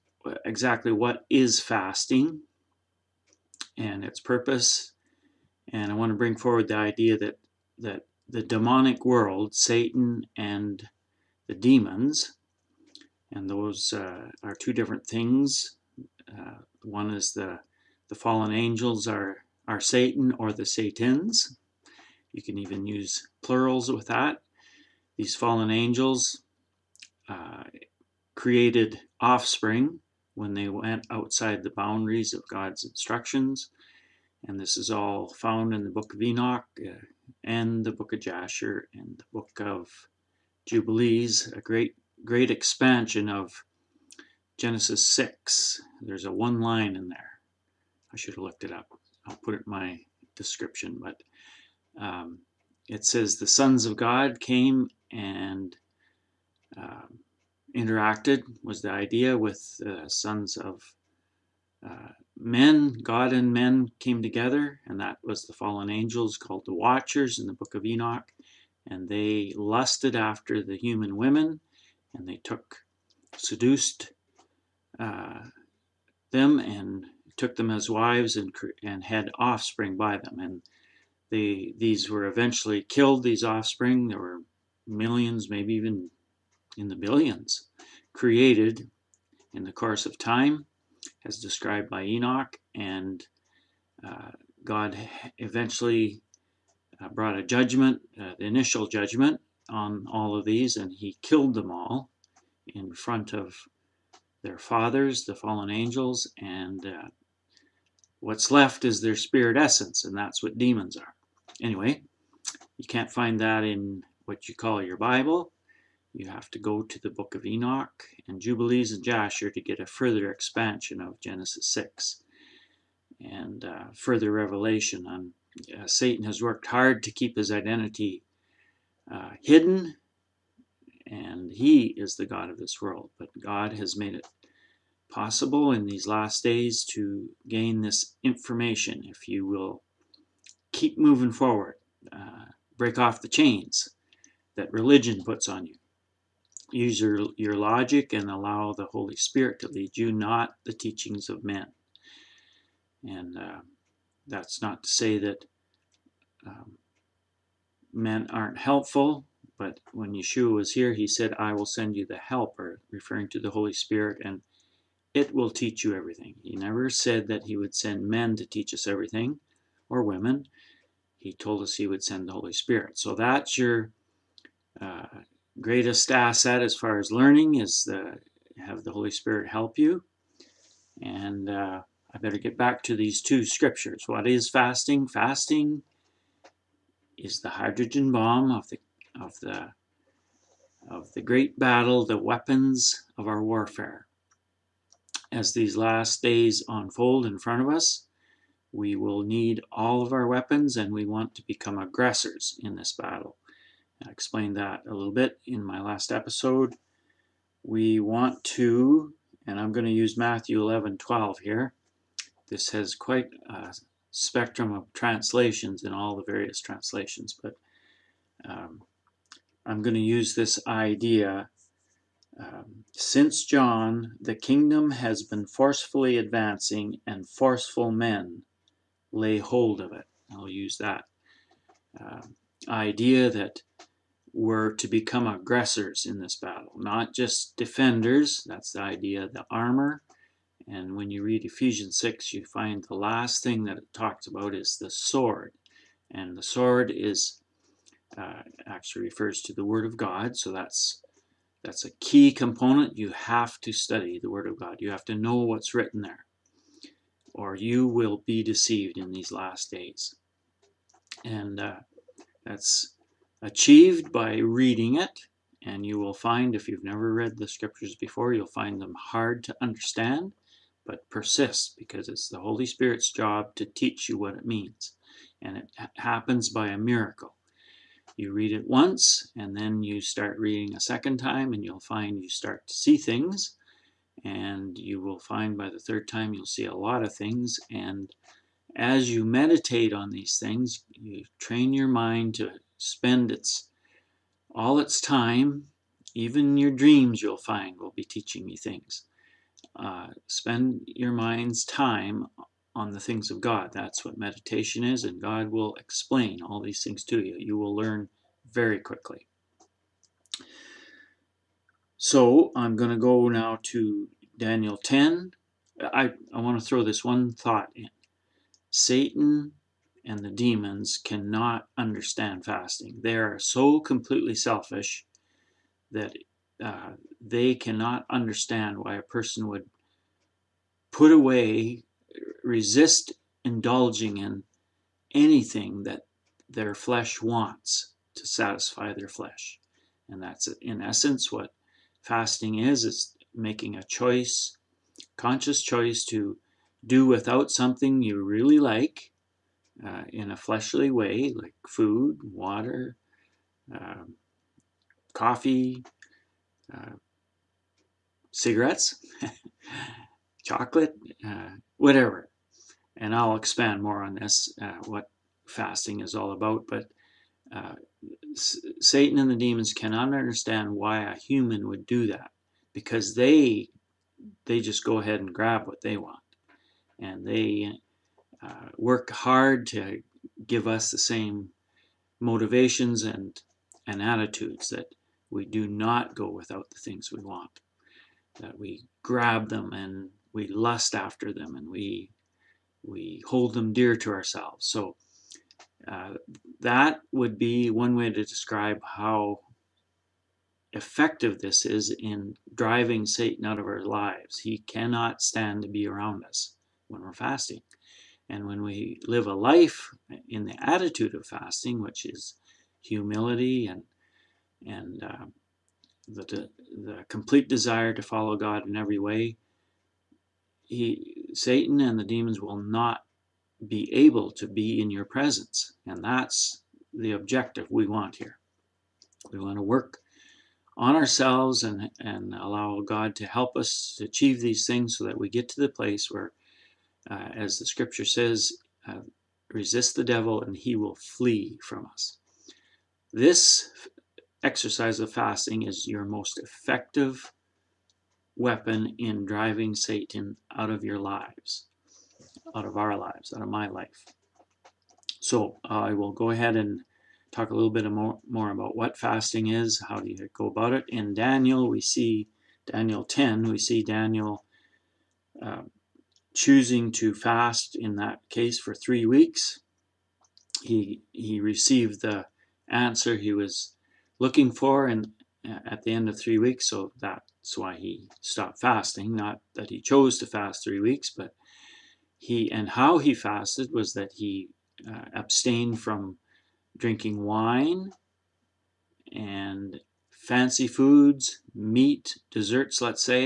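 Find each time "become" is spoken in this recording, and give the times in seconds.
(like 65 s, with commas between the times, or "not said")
201 s, 234 s.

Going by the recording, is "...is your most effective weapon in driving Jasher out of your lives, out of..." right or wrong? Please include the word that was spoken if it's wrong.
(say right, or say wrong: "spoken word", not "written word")
wrong: "Satan", not "Jasher".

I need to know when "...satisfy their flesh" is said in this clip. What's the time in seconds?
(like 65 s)
338 s.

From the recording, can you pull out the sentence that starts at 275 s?
And it happens by a miracle.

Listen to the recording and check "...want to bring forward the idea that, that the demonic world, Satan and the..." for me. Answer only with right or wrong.
right.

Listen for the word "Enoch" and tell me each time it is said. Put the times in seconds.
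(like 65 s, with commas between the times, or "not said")
36 s, 67 s, 92 s, 117 s.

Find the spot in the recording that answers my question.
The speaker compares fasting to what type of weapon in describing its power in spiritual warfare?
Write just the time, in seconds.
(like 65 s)
187 s.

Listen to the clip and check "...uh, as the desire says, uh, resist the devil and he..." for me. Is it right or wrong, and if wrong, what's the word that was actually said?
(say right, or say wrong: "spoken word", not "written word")
wrong: "scripture", not "desire".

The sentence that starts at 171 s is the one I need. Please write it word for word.
He told us he would send the Holy Spirit.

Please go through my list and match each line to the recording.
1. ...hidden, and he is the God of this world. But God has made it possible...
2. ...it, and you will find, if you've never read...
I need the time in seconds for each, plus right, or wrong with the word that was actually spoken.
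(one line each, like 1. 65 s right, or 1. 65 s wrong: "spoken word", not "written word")
1. 129 s right
2. 264 s right.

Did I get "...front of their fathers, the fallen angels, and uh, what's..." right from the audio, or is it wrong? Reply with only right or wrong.
right.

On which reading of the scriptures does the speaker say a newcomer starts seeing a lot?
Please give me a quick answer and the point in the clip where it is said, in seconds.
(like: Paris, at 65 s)
the third time, at 285 s.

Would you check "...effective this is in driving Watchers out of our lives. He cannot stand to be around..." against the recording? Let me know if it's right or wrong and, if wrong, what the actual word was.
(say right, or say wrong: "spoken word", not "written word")
wrong: "Satan", not "Watchers".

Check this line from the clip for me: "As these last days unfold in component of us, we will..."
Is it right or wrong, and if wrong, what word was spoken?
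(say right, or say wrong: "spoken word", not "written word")
wrong: "front", not "component".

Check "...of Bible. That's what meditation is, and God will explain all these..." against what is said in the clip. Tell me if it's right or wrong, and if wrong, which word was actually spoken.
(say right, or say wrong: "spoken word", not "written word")
wrong: "God", not "Bible".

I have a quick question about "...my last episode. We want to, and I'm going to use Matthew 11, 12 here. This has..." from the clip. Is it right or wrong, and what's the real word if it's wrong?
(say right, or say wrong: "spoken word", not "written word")
right.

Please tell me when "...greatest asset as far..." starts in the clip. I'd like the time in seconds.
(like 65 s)
175 s.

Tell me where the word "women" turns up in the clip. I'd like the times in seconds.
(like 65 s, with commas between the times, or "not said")
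71 s, 170 s.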